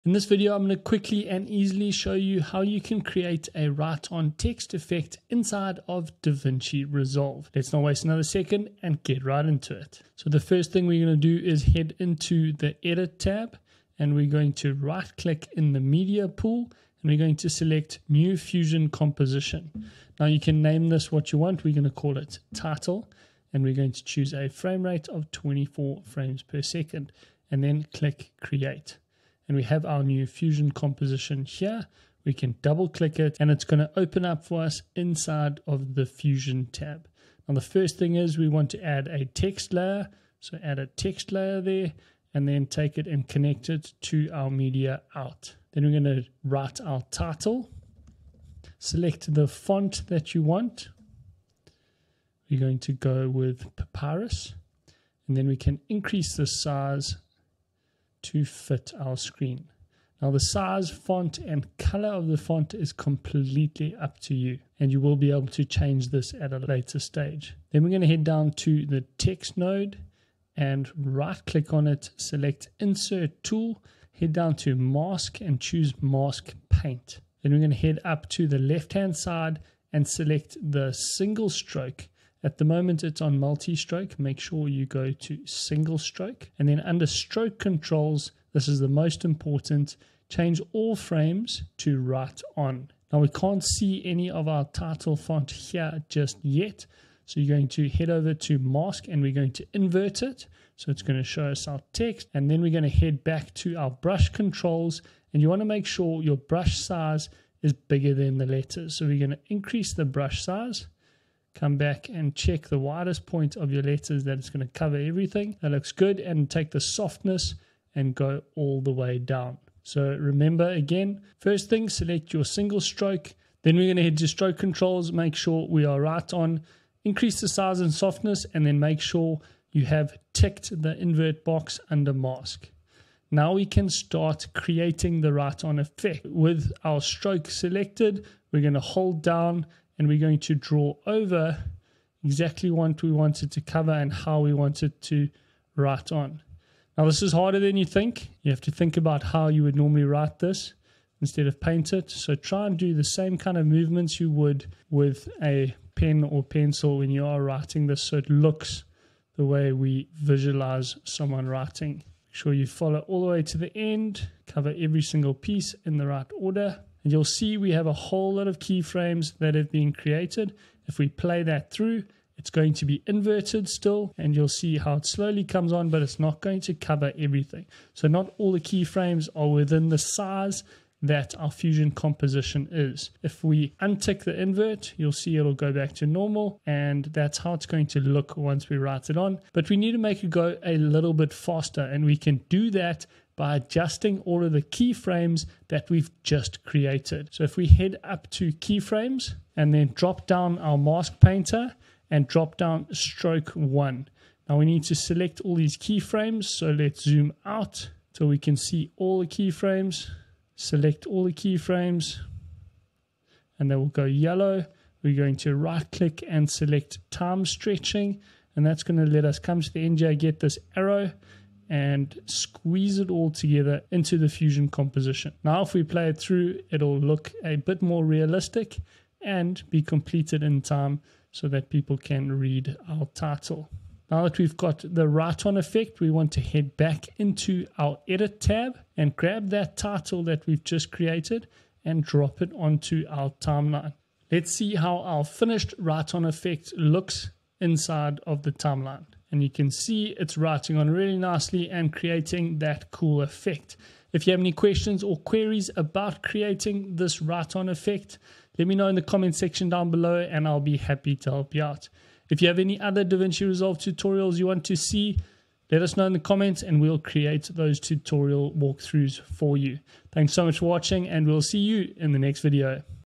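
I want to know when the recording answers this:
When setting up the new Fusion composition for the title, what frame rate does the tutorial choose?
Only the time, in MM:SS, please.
00:25.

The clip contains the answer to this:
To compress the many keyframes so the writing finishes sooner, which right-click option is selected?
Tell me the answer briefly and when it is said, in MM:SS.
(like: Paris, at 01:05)
Time stretching, at 03:37.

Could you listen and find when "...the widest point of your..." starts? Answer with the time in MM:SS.
01:52.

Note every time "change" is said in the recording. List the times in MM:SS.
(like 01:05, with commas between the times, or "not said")
01:05, 01:30.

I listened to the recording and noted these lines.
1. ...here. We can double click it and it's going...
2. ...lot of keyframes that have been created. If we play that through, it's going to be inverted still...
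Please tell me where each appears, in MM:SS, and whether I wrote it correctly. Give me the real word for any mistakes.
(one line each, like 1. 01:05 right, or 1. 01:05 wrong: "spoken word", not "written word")
1. 00:31 right
2. 02:48 right.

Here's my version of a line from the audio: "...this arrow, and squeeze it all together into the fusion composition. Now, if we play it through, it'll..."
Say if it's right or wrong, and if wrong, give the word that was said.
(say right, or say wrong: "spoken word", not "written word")
right.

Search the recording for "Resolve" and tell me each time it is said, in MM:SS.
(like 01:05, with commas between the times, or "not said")
00:06, 04:23.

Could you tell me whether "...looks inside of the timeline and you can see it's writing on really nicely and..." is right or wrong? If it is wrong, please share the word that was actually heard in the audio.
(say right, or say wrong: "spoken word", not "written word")
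right.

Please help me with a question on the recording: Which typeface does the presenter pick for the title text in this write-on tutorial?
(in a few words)
Papyrus.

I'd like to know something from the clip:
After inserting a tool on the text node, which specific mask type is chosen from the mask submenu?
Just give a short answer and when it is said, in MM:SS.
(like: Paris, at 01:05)
Mask paint, at 01:16.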